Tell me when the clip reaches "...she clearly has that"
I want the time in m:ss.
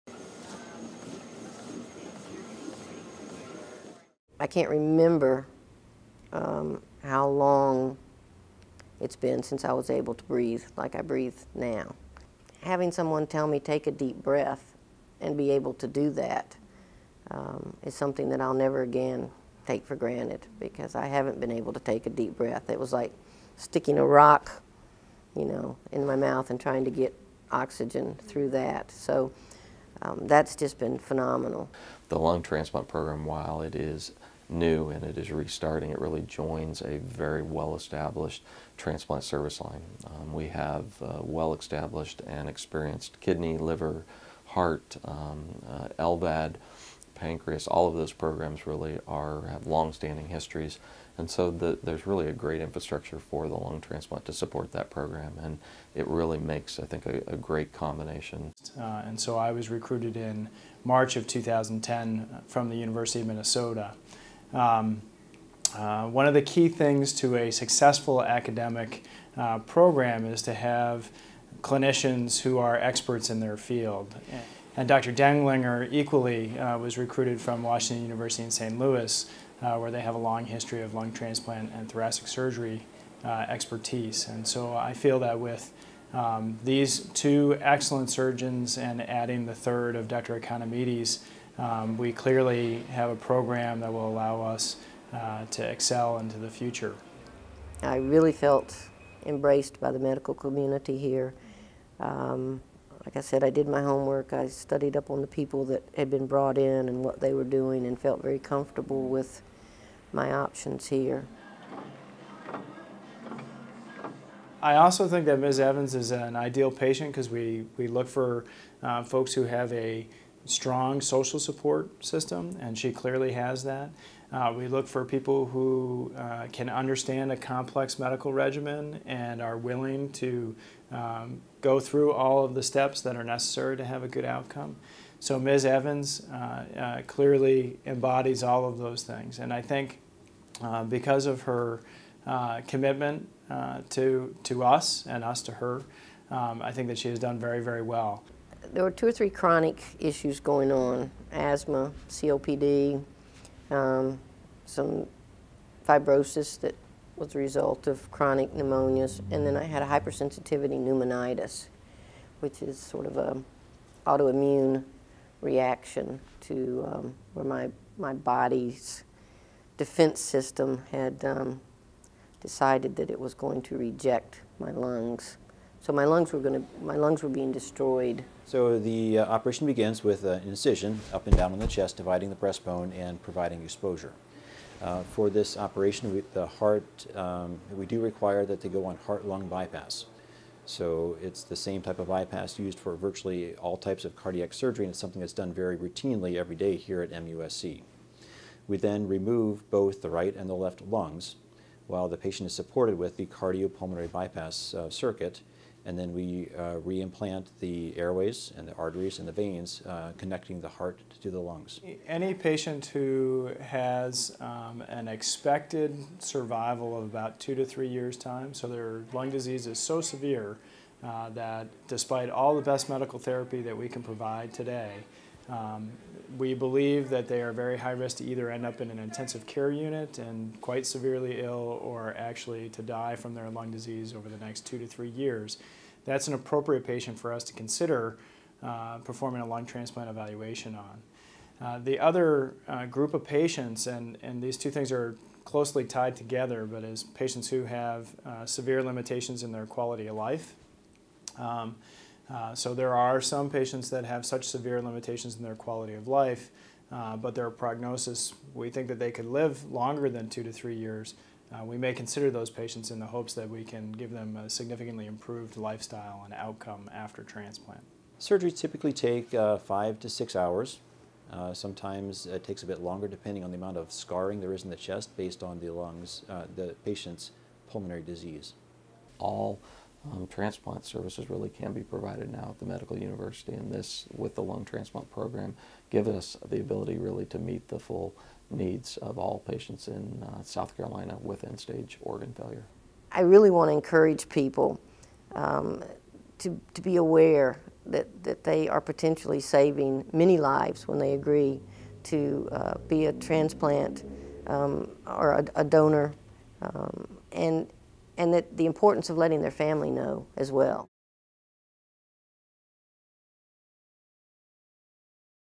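2:02.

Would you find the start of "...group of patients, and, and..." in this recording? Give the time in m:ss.
4:02.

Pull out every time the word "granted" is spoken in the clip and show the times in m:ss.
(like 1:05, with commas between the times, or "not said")
0:19.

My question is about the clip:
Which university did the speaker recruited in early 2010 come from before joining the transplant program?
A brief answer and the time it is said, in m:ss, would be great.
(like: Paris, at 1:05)
University of Minnesota, at 1:02.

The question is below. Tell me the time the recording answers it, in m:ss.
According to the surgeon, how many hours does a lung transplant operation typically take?
4:29.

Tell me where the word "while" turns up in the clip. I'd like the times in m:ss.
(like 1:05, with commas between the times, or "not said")
0:33, 3:21.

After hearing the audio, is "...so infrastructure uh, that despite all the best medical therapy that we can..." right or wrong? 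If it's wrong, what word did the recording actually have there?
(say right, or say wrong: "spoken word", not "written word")
wrong: "severe", not "infrastructure".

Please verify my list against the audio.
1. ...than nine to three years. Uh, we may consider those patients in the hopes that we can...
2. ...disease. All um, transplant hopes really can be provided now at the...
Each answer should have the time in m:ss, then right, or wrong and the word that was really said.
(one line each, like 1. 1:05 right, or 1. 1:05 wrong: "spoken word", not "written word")
1. 4:20 wrong: "two", not "nine"
2. 4:38 wrong: "services", not "hopes".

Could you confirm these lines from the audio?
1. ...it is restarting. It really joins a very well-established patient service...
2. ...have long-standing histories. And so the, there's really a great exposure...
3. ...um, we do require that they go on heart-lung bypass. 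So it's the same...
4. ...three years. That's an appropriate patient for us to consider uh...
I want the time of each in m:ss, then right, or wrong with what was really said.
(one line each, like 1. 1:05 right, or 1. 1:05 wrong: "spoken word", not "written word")
1. 0:35 wrong: "transplant", not "patient"
2. 0:49 wrong: "infrastructure", not "exposure"
3. 3:07 right
4. 3:54 right.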